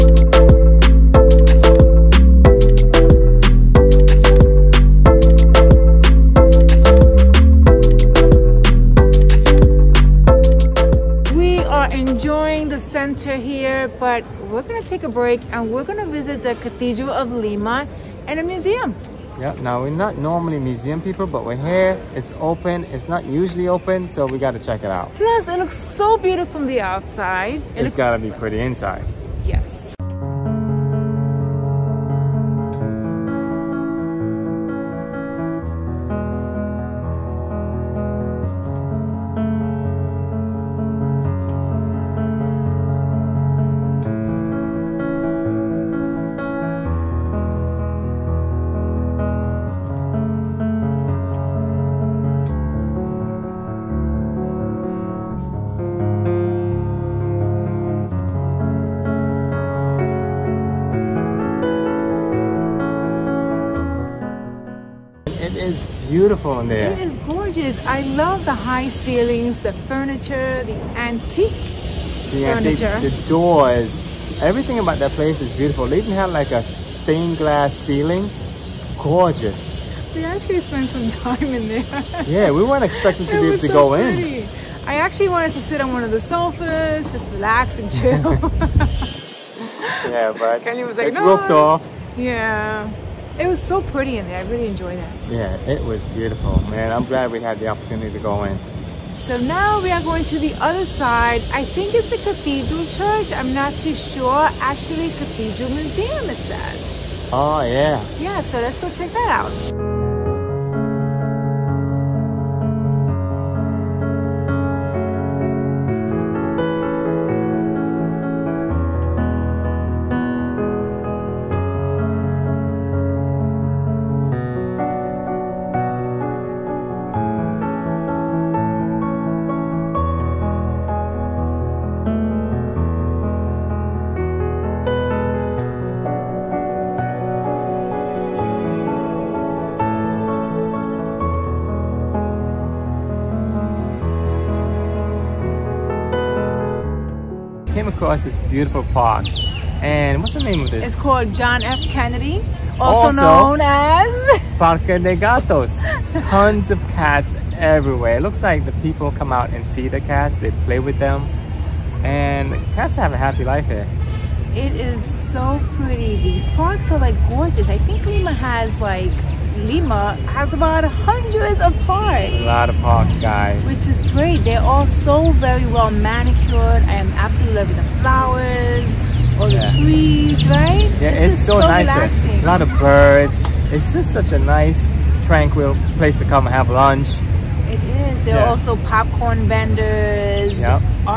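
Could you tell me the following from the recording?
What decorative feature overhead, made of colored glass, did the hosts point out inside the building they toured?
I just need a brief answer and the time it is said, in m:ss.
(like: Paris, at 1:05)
stained glass ceiling, at 1:16.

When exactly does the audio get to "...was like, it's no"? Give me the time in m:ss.
1:30.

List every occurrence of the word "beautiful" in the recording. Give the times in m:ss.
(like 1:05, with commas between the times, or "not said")
0:26, 1:06, 1:15, 1:36, 2:28.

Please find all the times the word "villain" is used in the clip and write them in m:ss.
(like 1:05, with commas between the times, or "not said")
not said.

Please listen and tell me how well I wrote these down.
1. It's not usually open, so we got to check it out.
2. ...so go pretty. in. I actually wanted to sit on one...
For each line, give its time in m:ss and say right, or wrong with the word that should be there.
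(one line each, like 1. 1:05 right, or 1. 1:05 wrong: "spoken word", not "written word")
1. 0:22 right
2. 1:23 right.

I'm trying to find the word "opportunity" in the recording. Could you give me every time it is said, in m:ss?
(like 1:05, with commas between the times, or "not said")
1:37.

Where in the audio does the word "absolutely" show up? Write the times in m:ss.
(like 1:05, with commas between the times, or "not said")
2:57.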